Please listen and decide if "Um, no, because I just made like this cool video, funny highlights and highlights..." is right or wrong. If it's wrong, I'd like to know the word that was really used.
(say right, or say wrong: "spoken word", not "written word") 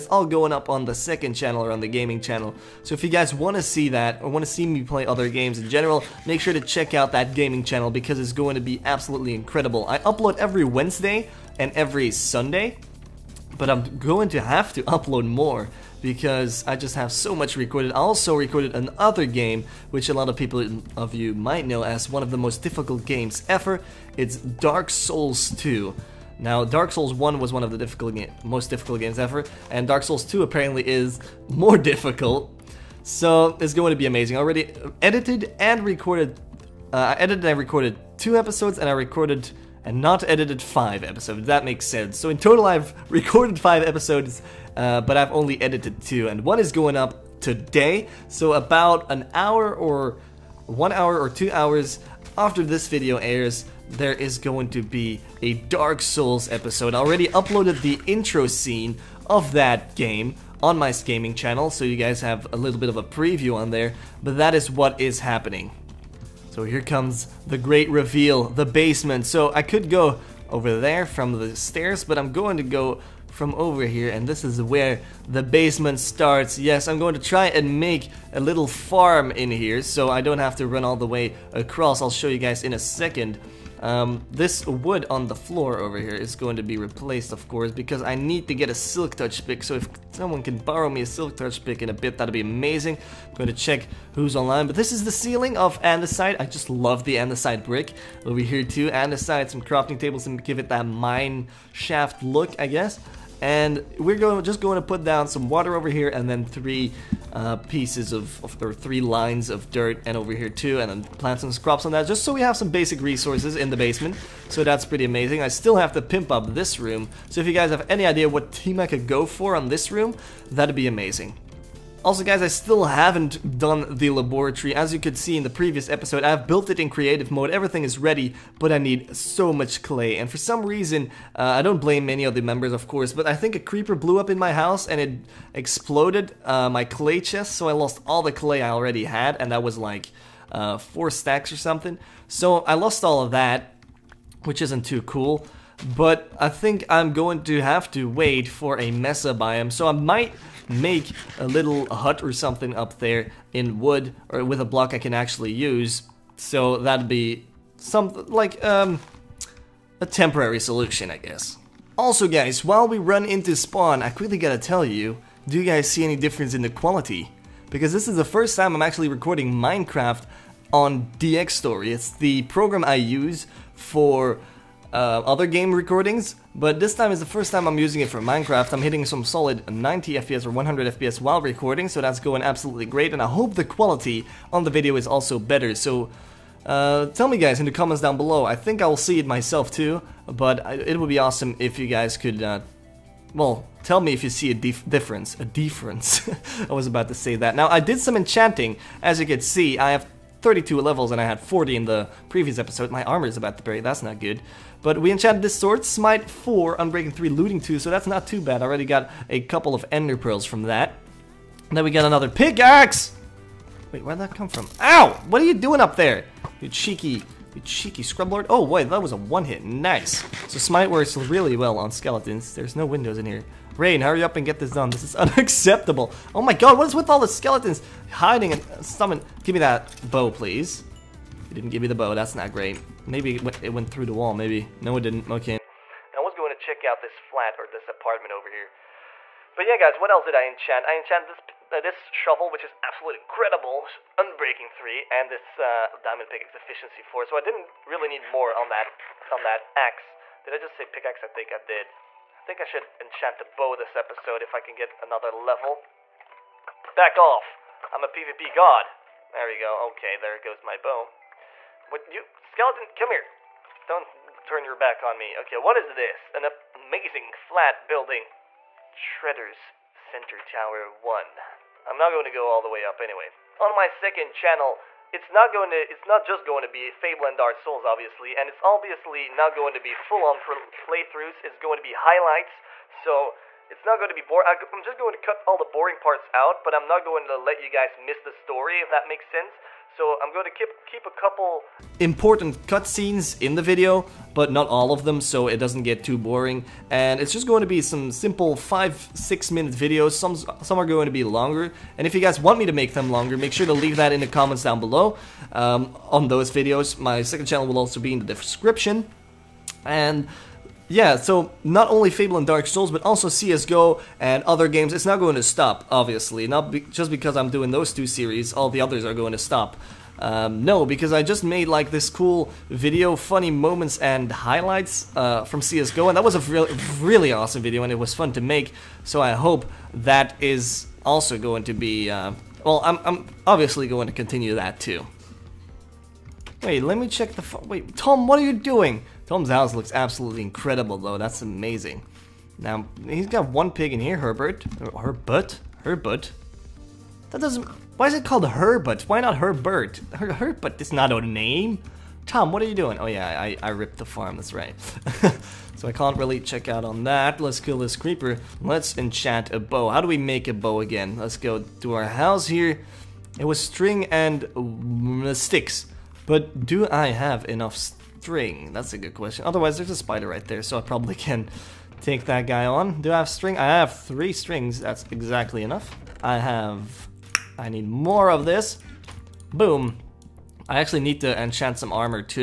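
wrong: "moments", not "highlights".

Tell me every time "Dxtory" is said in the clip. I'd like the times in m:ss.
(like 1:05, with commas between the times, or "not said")
2:51.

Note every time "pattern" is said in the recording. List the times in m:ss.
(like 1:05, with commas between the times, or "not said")
not said.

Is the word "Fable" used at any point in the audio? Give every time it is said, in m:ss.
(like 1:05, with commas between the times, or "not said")
4:36, 5:12.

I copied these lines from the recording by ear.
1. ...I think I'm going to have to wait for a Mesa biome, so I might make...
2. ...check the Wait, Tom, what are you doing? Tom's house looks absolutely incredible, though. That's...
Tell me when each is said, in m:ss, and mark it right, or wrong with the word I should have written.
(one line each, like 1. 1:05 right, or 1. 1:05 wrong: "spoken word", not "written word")
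1. 2:26 right
2. 5:37 right.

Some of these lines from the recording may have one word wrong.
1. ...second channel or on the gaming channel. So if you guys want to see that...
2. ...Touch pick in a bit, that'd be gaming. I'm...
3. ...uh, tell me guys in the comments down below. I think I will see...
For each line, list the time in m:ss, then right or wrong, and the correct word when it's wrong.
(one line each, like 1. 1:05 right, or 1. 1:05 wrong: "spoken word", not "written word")
1. 0:00 right
2. 1:31 wrong: "amazing", not "gaming"
3. 3:06 right.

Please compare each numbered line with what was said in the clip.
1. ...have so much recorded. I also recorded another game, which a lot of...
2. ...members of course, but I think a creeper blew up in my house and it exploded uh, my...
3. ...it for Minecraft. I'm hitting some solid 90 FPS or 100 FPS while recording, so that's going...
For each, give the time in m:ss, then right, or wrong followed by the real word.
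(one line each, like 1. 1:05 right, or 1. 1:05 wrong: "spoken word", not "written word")
1. 0:16 right
2. 2:12 right
3. 2:58 right.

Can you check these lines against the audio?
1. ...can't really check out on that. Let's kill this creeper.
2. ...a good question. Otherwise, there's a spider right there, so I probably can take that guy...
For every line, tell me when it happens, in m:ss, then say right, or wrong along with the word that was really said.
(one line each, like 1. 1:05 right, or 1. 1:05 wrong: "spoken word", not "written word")
1. 5:55 right
2. 6:08 right.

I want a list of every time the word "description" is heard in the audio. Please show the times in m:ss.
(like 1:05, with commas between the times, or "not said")
5:08.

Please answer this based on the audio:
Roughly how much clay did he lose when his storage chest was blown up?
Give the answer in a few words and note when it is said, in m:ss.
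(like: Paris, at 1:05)
4 stacks, at 2:20.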